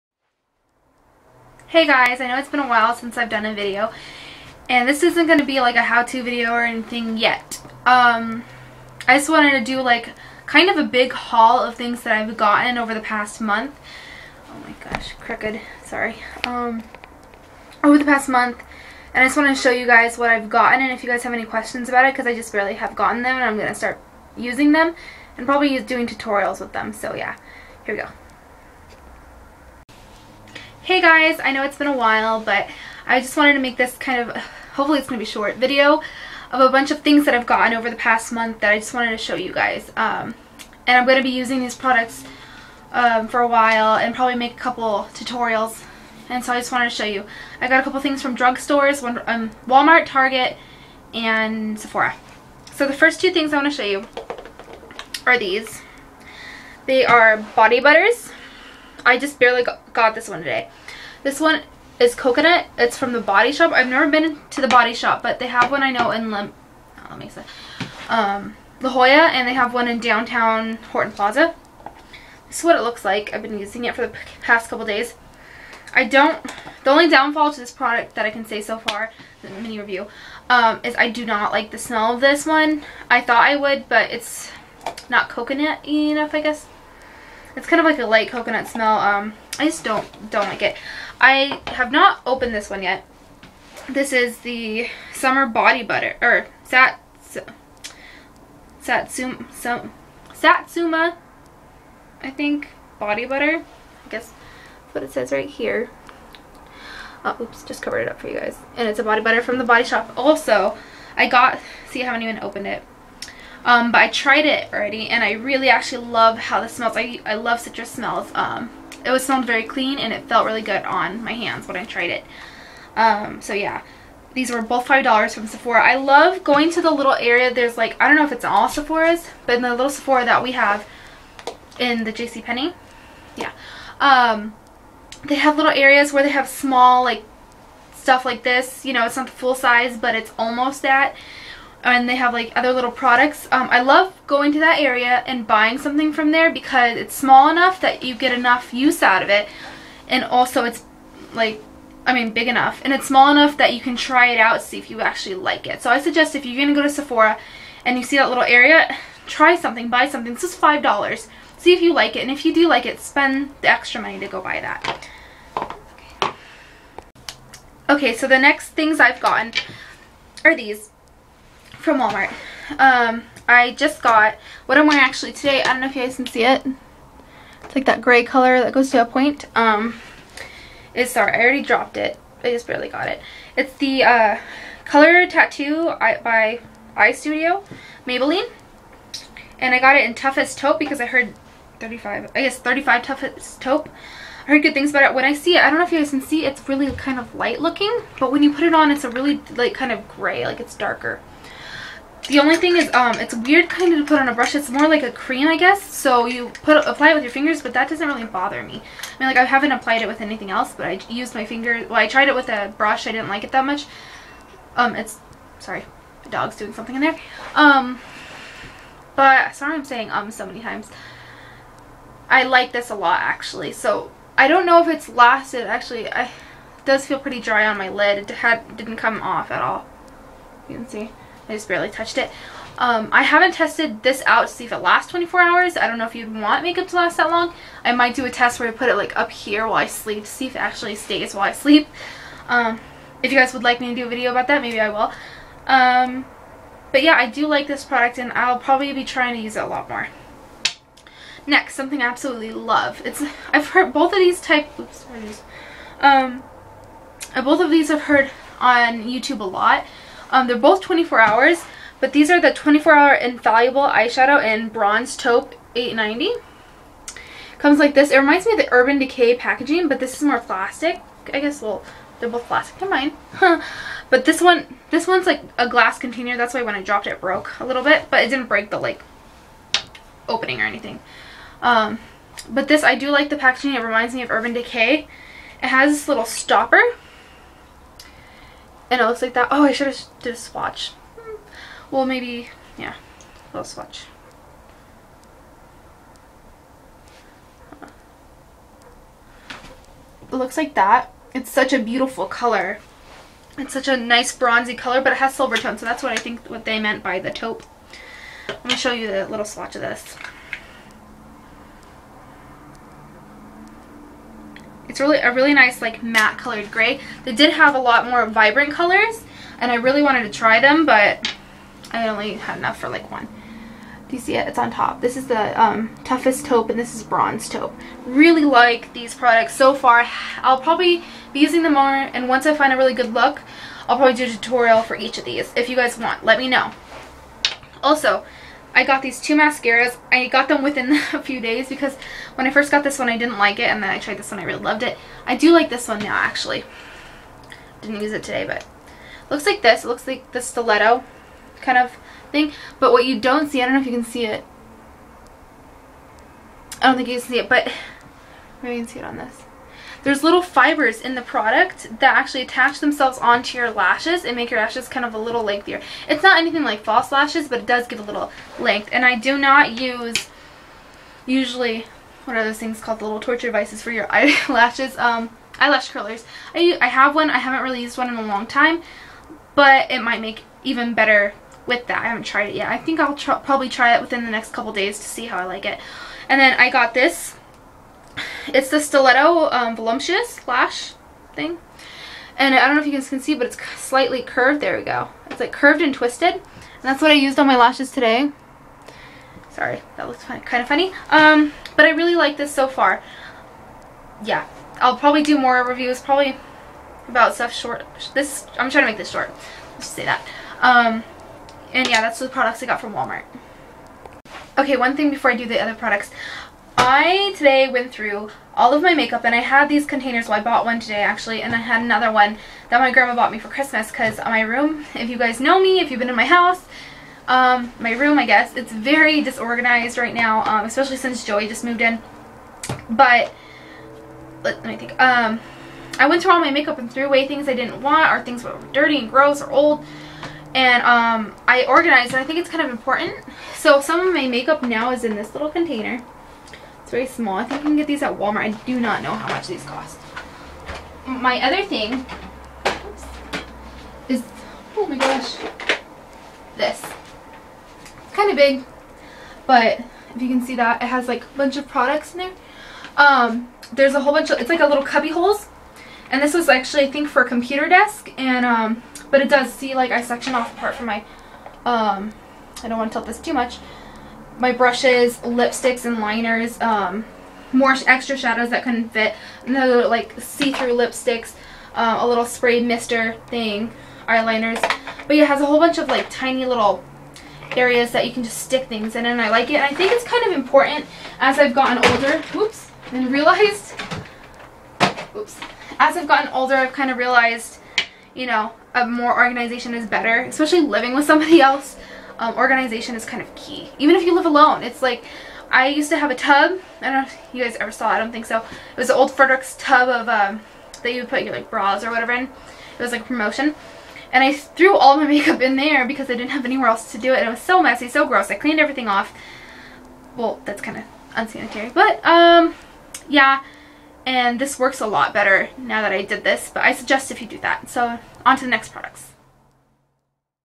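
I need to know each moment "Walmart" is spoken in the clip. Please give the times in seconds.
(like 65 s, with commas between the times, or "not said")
49 s, 171 s, 412 s, 448 s.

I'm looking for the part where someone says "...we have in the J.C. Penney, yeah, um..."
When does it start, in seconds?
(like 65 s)
130 s.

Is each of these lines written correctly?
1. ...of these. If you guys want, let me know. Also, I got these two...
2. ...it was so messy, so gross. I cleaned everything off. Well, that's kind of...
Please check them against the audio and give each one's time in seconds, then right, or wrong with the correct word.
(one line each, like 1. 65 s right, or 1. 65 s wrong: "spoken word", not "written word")
1. 335 s right
2. 517 s right.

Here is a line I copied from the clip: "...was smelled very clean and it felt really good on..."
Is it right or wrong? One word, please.
right.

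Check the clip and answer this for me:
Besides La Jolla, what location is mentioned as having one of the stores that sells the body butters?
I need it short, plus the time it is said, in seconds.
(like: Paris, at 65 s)
Horton Plaza, at 69 s.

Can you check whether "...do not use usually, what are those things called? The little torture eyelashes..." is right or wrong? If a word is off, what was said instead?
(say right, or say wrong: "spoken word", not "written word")
wrong: "devices", not "eyelashes".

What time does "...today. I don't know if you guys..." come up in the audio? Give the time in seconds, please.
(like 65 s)
175 s.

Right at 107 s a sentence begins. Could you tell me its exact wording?
Oh, oops, just covered it up for you guys.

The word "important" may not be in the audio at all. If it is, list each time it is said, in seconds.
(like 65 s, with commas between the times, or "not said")
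442 s, 490 s.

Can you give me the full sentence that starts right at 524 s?
And this works a lot better now that I did this.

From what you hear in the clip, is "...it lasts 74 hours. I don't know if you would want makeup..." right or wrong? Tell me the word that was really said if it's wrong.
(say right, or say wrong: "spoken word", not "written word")
wrong: "24", not "74".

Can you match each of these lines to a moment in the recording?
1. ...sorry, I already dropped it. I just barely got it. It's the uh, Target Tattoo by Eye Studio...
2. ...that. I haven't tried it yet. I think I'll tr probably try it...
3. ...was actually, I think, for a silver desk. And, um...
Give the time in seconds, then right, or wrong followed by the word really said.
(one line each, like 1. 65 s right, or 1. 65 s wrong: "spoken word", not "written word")
1. 181 s wrong: "Color", not "Target"
2. 381 s right
3. 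466 s wrong: "computer", not "silver".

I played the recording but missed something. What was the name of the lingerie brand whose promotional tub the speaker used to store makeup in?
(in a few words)
Fredericks.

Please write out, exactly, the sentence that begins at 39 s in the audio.
Um, and I'm going to be using these products um, for a while and probably make a couple tutorials.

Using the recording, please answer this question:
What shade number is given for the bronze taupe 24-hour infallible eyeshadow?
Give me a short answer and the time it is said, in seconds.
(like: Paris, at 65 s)
890, at 264 s.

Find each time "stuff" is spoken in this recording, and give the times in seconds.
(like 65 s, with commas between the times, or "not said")
137 s, 407 s.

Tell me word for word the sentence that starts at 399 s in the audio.
Sorry, that looks fun, kind of funny.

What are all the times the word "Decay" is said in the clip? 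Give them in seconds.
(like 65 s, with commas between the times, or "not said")
268 s, 284 s.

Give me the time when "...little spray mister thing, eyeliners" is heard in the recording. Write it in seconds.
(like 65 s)
482 s.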